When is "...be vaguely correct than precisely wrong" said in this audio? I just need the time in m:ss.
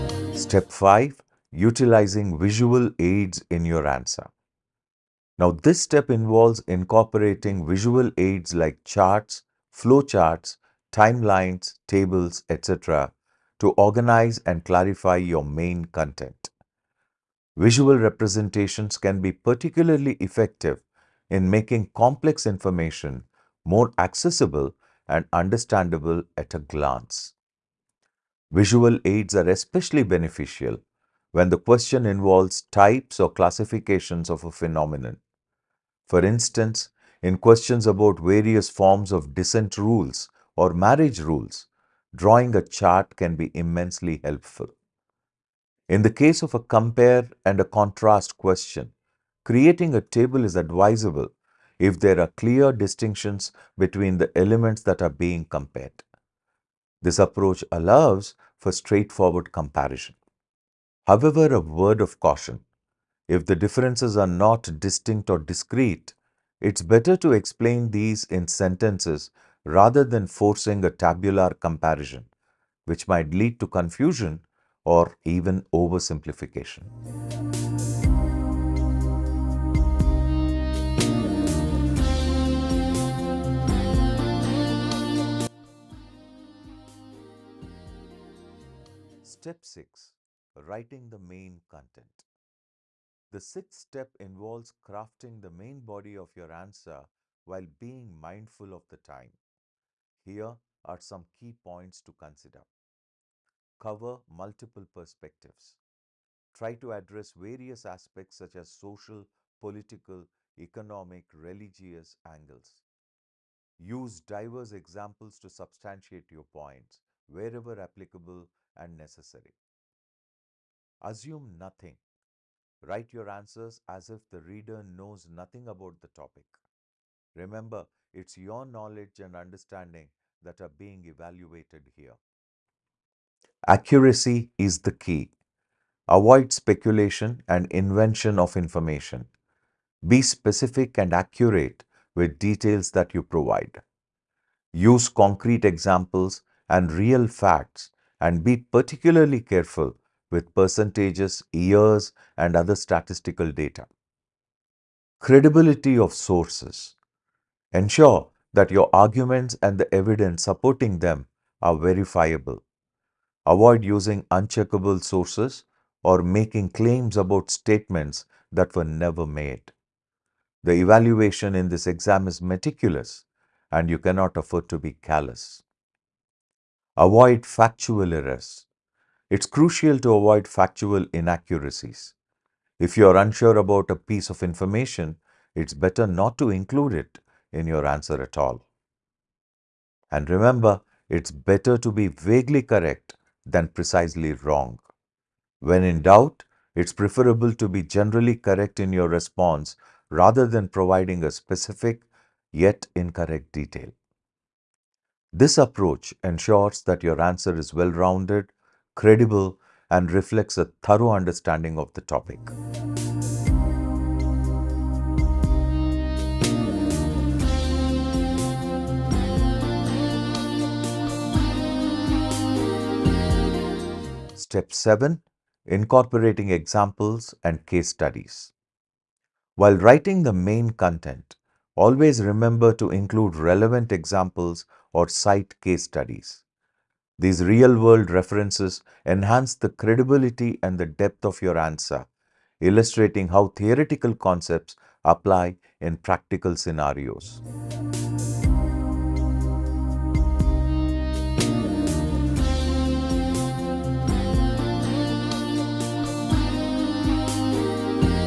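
3:11.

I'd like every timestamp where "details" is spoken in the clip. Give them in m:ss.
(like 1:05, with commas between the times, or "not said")
2:22, 3:23.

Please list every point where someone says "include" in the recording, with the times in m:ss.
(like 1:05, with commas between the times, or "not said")
3:06, 3:52.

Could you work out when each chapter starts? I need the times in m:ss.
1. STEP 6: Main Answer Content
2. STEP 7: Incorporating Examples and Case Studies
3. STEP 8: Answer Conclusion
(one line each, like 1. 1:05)
1. 1:22
2. 3:34
3. 4:08.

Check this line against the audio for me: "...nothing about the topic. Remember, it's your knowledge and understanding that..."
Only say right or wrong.
right.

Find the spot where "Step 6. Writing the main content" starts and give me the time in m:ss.
1:29.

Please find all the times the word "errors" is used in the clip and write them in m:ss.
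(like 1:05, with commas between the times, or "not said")
2:58.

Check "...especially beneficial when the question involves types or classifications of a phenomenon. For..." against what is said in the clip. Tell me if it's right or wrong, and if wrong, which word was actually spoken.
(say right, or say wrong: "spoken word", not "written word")
right.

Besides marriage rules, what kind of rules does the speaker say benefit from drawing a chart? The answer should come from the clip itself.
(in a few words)
Descent rules.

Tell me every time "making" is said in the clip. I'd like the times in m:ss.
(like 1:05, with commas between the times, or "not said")
0:21, 2:46.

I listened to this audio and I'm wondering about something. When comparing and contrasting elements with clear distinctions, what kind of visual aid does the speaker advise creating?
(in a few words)
A table.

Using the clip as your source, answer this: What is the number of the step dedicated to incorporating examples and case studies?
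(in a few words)
7.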